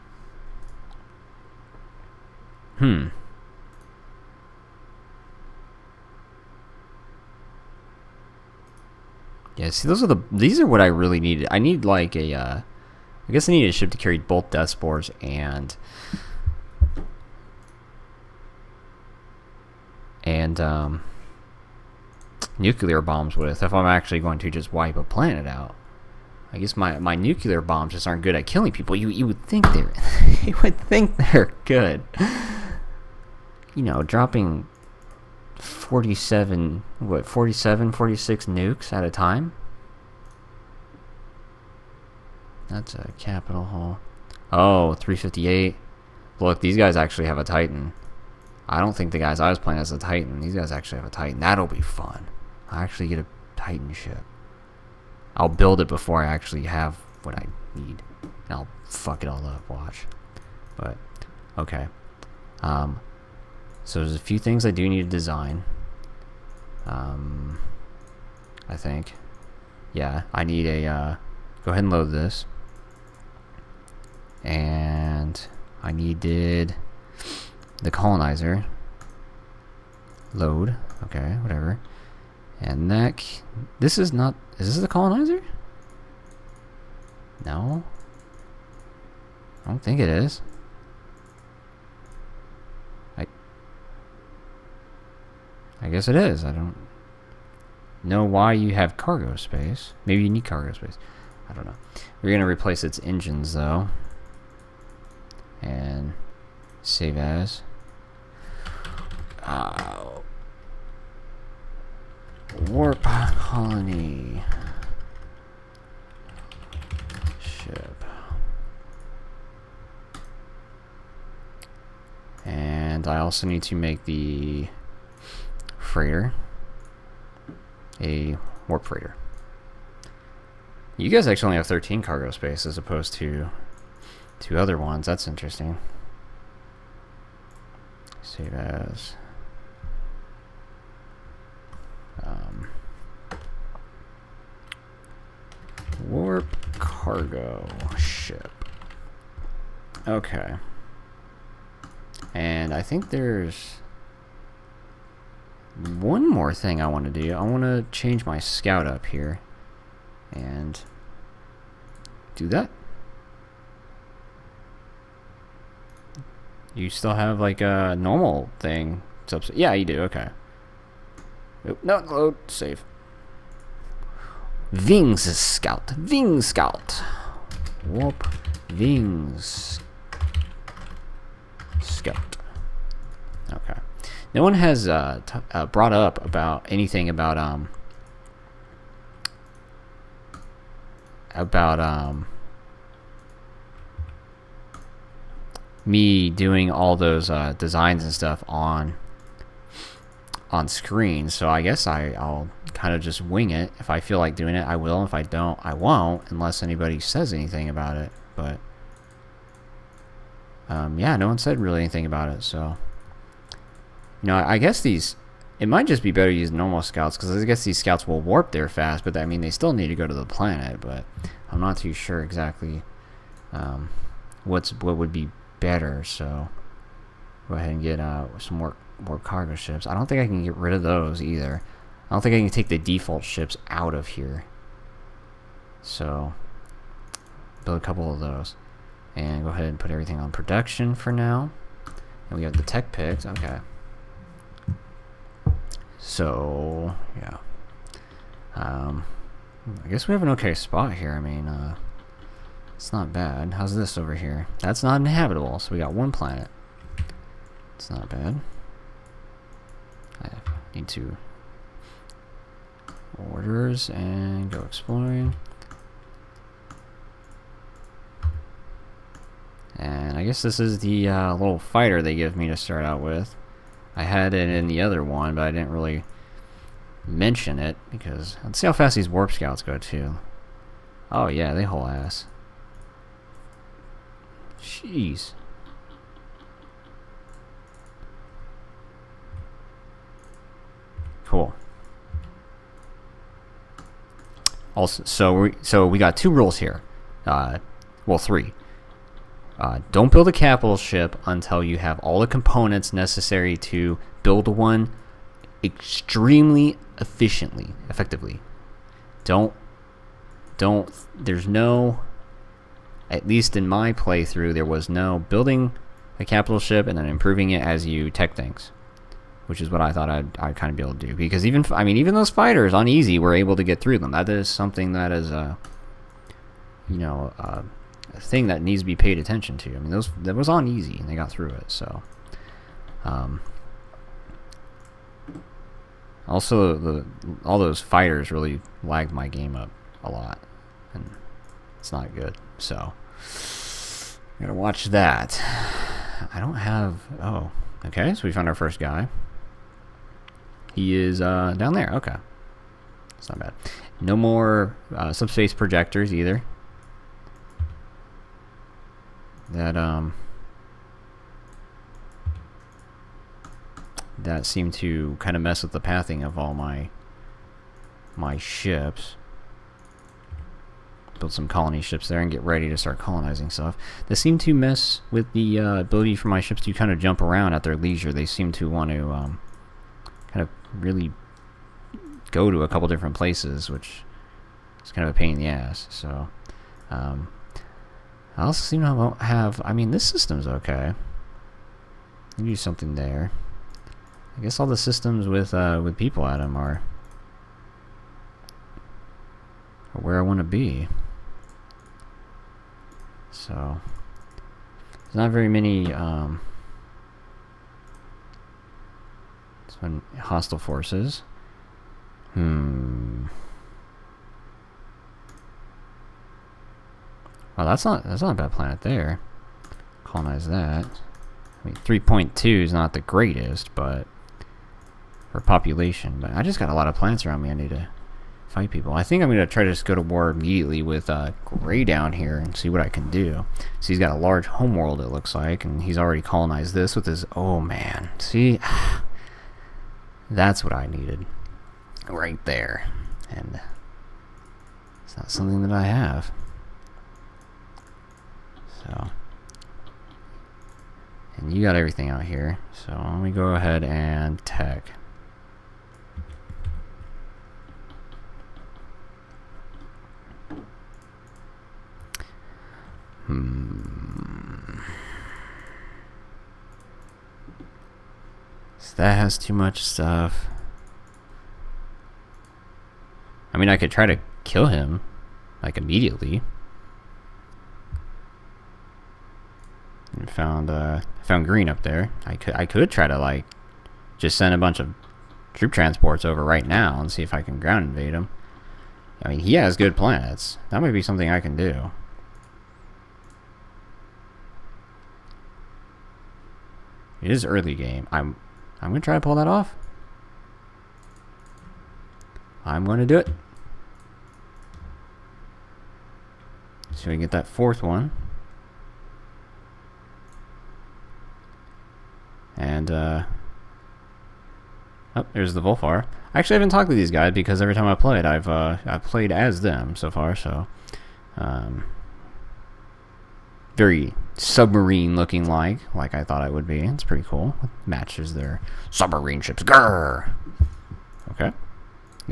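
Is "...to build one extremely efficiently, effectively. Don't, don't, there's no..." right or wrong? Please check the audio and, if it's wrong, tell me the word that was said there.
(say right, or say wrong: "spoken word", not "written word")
right.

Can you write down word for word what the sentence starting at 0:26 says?
I guess my, my nuclear bombs just aren't good at killing people.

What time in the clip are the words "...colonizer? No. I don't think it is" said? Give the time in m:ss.
1:24.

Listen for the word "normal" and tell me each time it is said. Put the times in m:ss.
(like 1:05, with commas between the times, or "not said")
2:47, 3:36.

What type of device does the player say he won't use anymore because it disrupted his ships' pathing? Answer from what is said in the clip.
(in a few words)
subspace projectors.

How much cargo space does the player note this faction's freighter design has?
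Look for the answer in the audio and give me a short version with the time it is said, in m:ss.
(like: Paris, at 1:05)
13, at 2:11.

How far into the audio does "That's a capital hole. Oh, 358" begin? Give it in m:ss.
0:42.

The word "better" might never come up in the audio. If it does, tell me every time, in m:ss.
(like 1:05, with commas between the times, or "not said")
3:36, 3:45.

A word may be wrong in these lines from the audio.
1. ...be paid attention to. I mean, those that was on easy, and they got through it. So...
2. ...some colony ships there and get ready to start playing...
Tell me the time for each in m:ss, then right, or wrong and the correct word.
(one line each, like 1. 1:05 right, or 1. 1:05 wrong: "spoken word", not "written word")
1. 5:28 right
2. 6:11 wrong: "colonizing", not "playing".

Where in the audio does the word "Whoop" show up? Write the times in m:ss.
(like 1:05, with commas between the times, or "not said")
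2:57.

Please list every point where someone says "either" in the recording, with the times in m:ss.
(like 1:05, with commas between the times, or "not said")
3:51, 5:56.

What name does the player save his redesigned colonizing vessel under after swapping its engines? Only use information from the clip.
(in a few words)
warp colony ship.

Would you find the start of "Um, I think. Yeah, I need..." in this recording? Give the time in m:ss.
1:06.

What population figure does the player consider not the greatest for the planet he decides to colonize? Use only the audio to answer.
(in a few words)
3.2.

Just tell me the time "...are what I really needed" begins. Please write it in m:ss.
0:10.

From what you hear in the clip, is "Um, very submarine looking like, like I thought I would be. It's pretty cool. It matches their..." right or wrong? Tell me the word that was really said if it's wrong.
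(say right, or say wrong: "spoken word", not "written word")
right.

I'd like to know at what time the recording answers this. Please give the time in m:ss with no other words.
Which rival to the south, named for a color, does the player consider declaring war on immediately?
7:11.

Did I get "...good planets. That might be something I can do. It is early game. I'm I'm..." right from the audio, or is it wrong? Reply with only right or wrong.
right.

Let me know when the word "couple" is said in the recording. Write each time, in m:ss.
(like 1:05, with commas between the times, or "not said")
3:57, 6:22.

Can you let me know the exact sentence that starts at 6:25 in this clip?
So um, I also seem to have, I mean, this system's okay.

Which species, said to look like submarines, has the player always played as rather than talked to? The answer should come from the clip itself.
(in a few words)
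Vulfar.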